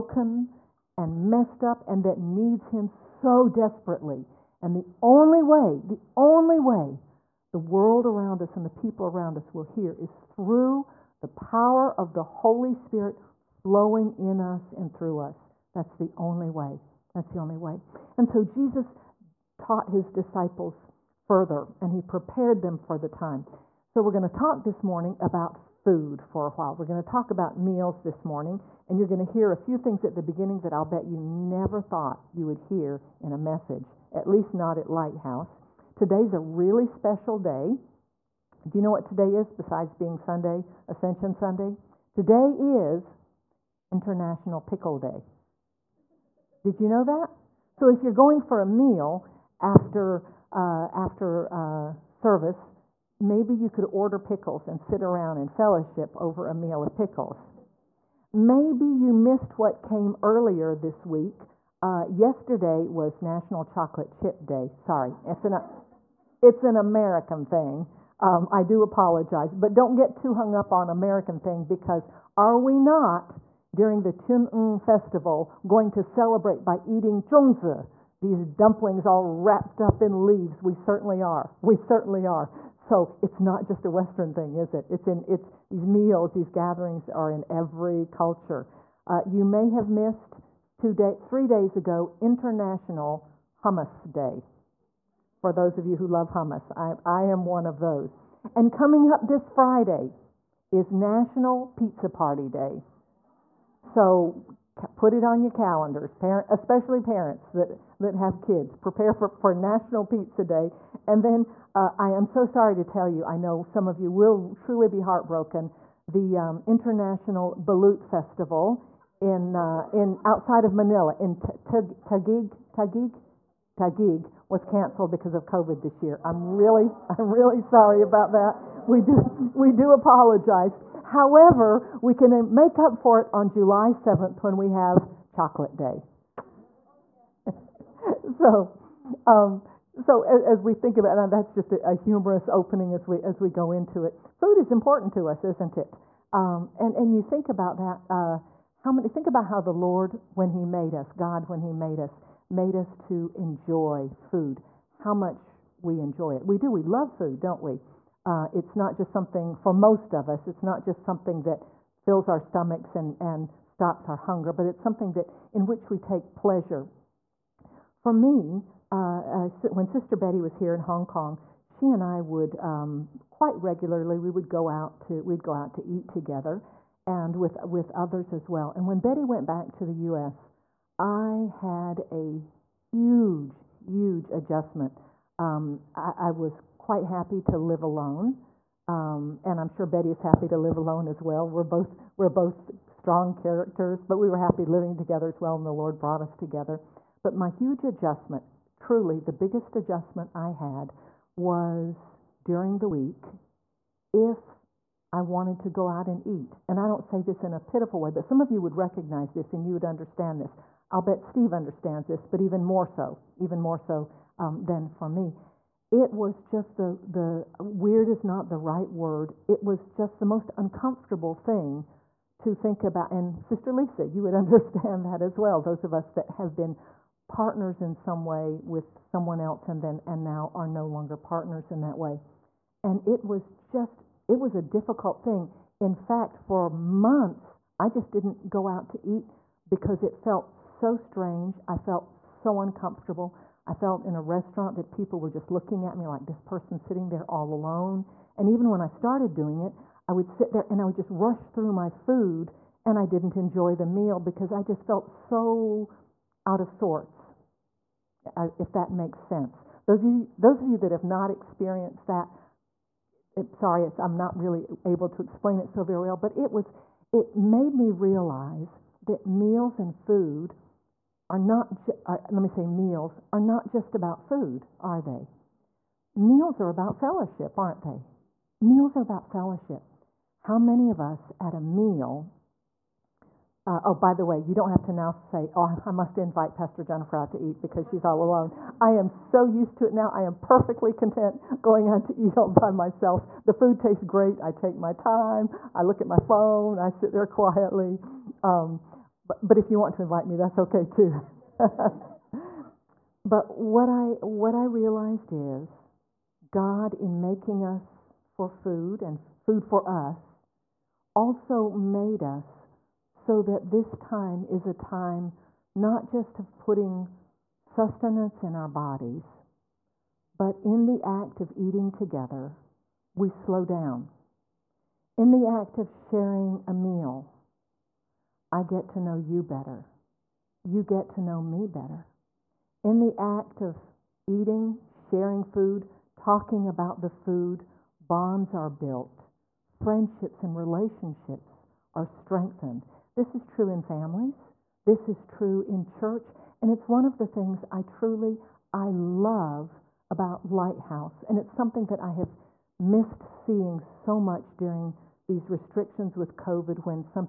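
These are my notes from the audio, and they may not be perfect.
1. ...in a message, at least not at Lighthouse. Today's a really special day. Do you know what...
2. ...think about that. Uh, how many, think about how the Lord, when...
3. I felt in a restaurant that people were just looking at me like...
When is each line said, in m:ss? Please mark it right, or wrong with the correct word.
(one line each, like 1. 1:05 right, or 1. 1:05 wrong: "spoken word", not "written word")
1. 0:33 right
2. 2:27 right
3. 4:03 right.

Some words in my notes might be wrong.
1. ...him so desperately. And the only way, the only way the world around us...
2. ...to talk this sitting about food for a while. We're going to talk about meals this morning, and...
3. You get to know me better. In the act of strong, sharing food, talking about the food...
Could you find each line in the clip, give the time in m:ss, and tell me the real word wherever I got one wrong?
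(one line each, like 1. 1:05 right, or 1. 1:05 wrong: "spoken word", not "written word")
1. 0:02 right
2. 0:24 wrong: "morning", not "sitting"
3. 5:30 wrong: "eating", not "strong".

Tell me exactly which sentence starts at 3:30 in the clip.
I'll bet Steve understands this, but even more so, even more so um, than for me.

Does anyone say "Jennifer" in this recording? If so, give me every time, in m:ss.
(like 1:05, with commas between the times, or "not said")
4:46.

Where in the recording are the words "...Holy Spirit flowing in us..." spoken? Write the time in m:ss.
0:12.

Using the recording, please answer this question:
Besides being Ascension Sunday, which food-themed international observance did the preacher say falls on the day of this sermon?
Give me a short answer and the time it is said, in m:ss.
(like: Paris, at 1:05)
International Pickle Day, at 0:43.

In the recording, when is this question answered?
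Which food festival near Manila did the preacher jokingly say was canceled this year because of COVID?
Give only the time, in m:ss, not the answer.
1:56.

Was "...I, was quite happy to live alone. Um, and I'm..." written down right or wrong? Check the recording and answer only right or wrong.
right.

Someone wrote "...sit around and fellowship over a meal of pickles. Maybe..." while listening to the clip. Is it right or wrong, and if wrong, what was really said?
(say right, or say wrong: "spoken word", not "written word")
right.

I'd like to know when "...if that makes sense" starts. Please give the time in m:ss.
4:18.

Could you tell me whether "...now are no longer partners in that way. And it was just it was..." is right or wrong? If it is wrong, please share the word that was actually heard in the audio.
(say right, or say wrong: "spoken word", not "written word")
right.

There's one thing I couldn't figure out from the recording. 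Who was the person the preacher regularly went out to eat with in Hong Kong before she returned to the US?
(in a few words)
Sister Betty.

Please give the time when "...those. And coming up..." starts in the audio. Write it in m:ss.
1:37.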